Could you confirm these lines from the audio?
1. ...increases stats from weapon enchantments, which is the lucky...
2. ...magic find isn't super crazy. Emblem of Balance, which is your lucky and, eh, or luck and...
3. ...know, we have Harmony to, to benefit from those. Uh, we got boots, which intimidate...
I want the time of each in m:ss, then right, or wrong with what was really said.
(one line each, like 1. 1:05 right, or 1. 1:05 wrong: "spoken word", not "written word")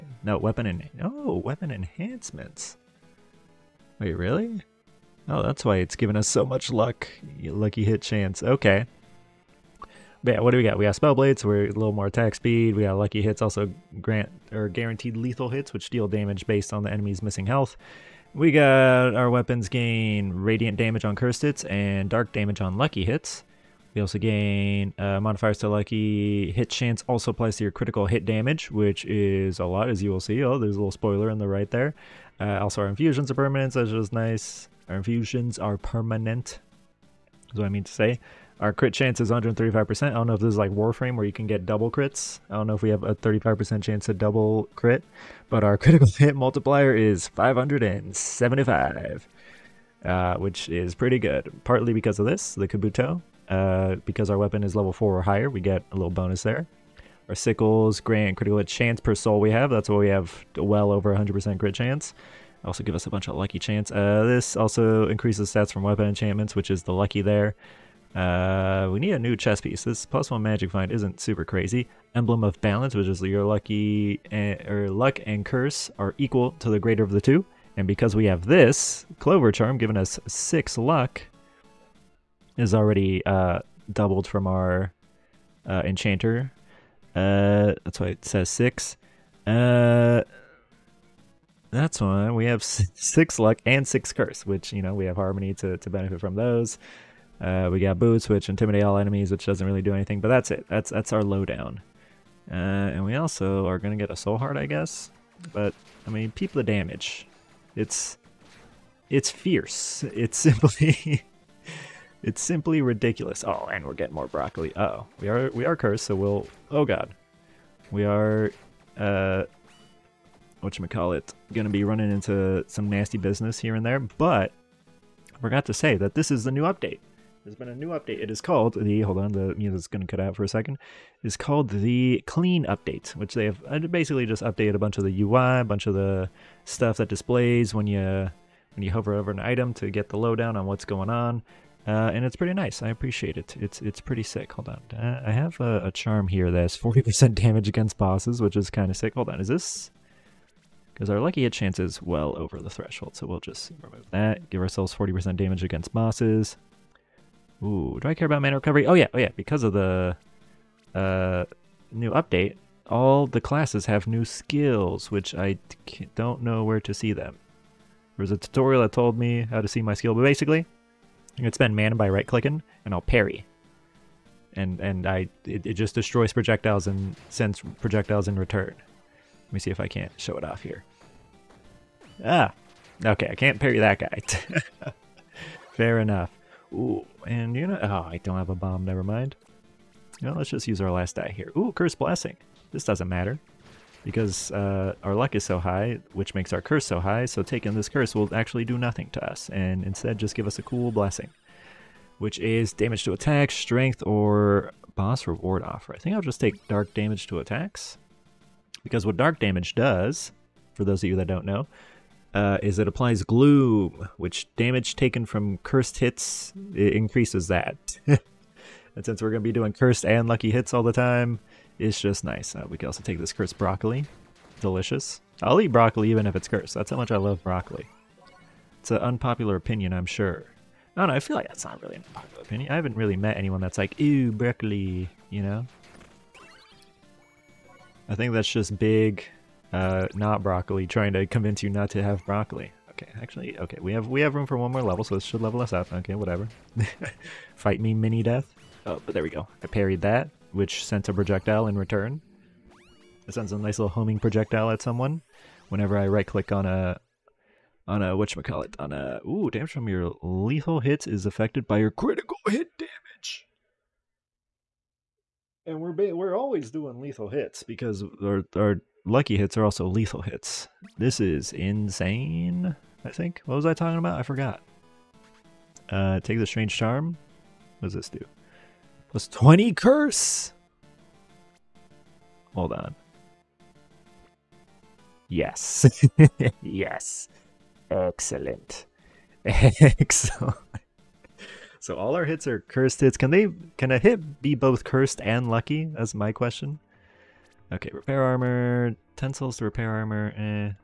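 1. 1:05 right
2. 1:10 right
3. 1:34 right.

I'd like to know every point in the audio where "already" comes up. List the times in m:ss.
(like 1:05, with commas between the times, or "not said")
1:22.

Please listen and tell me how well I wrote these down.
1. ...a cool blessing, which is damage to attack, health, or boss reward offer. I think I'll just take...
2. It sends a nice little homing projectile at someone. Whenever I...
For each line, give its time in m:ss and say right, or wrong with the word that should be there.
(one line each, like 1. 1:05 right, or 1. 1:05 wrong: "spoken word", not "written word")
1. 3:20 wrong: "strength", not "health"
2. 4:13 right.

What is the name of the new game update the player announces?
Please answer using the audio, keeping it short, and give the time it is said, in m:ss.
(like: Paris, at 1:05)
Clean Update, at 2:12.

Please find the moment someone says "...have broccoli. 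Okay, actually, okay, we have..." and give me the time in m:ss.
4:02.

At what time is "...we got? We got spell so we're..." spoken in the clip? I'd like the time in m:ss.
0:10.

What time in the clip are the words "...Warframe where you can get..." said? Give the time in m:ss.
0:40.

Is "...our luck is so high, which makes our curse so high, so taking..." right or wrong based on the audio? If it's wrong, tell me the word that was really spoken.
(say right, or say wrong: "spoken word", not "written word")
right.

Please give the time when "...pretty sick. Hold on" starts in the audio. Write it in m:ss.
2:24.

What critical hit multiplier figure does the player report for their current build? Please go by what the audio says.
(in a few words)
575.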